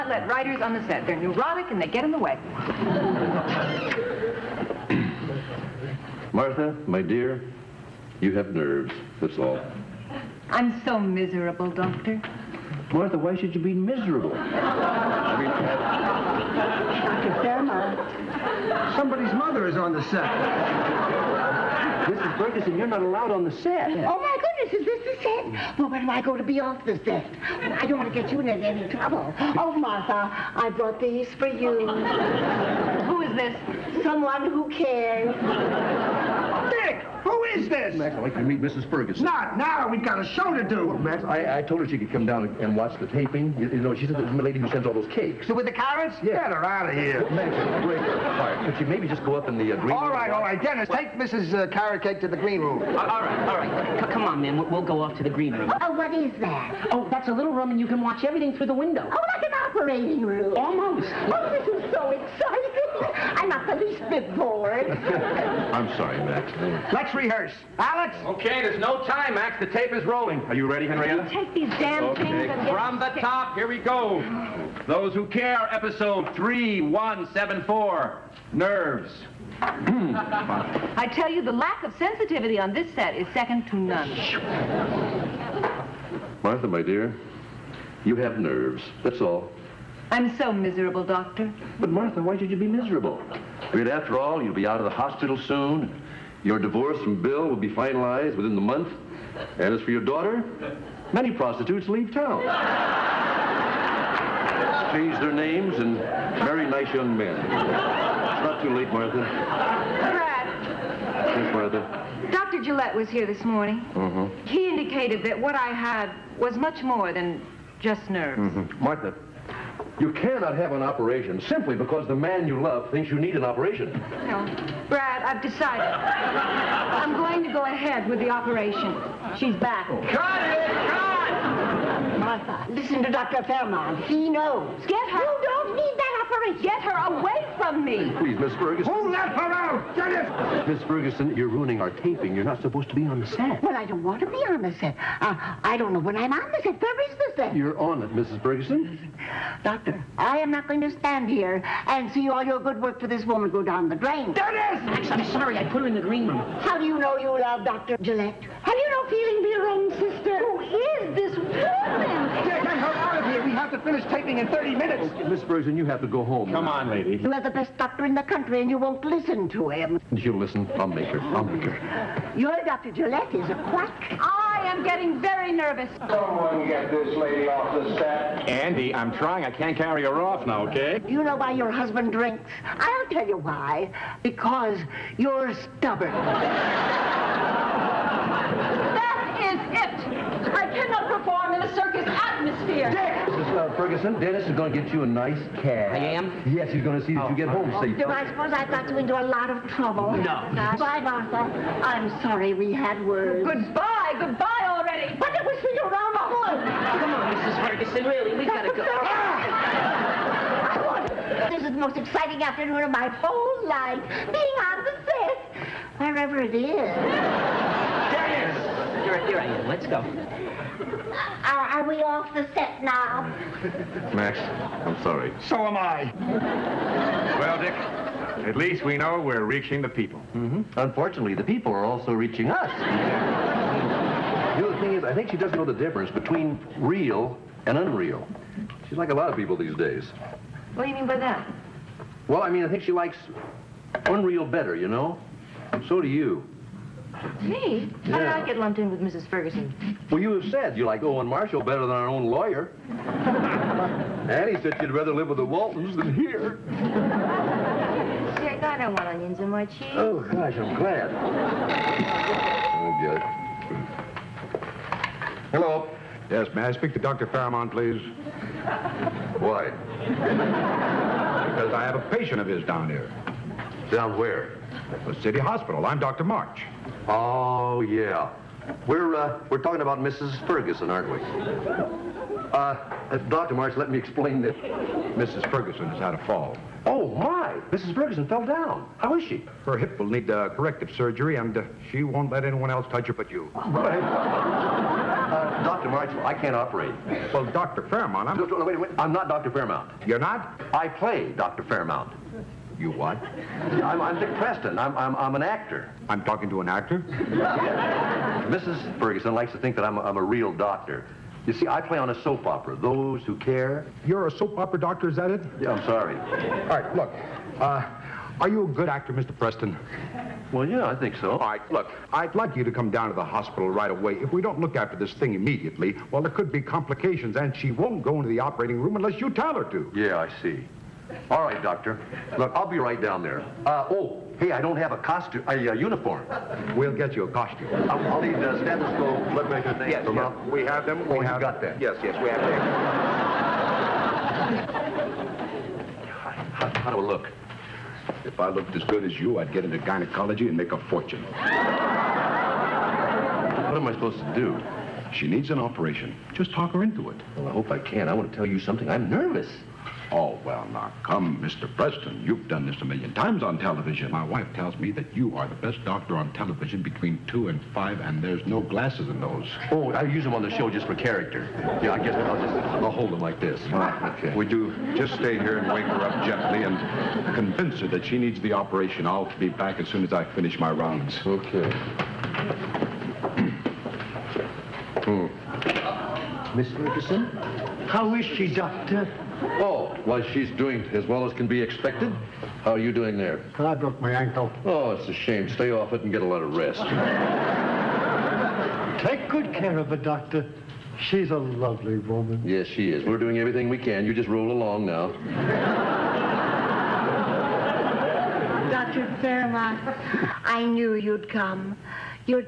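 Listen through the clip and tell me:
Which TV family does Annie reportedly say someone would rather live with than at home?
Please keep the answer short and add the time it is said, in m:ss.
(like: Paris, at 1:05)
The Waltons, at 4:15.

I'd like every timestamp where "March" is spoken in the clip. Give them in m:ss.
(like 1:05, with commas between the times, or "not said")
4:36, 4:43, 4:55.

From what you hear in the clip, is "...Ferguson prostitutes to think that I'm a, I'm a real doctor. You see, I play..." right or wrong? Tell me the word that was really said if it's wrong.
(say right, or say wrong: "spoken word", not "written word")
wrong: "likes", not "prostitutes".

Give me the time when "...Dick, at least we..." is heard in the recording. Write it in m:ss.
3:47.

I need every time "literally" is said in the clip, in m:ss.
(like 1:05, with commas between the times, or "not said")
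not said.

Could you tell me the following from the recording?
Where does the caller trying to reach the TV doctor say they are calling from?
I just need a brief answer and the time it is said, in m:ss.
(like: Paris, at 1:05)
The city hospital, at 4:35.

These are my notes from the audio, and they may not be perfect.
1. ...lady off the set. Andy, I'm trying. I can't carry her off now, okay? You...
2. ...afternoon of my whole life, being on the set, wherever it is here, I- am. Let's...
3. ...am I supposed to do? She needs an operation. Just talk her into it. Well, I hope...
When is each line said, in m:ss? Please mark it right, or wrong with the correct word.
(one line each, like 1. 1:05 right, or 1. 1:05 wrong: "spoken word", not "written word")
1. 2:57 right
2. 3:32 right
3. 5:53 right.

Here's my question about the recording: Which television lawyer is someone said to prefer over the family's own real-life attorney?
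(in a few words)
Owen Marshall.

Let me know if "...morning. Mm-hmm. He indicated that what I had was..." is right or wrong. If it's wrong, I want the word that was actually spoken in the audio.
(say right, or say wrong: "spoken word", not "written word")
right.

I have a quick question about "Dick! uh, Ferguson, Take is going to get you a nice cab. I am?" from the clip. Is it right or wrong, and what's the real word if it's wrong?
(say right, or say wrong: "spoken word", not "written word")
wrong: "Dennis", not "Take".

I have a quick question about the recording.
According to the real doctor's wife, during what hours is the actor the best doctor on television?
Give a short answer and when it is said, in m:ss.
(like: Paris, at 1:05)
Between 2 and 5, at 6:06.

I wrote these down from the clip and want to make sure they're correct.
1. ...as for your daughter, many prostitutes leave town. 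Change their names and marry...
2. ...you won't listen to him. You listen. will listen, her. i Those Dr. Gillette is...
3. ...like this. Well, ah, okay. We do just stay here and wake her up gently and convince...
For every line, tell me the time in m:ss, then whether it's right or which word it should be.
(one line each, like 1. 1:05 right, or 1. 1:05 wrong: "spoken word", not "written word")
1. 1:39 right
2. 2:48 wrong: "Your", not "Those"
3. 6:13 right.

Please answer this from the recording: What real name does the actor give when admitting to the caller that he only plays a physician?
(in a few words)
Dick Preston.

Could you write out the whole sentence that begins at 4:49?
Her hip will need uh, corrective surgery, and uh, she won't let anyone else touch her but you.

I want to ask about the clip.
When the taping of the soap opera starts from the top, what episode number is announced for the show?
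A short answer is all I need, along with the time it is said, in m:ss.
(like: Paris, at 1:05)
3174, at 1:16.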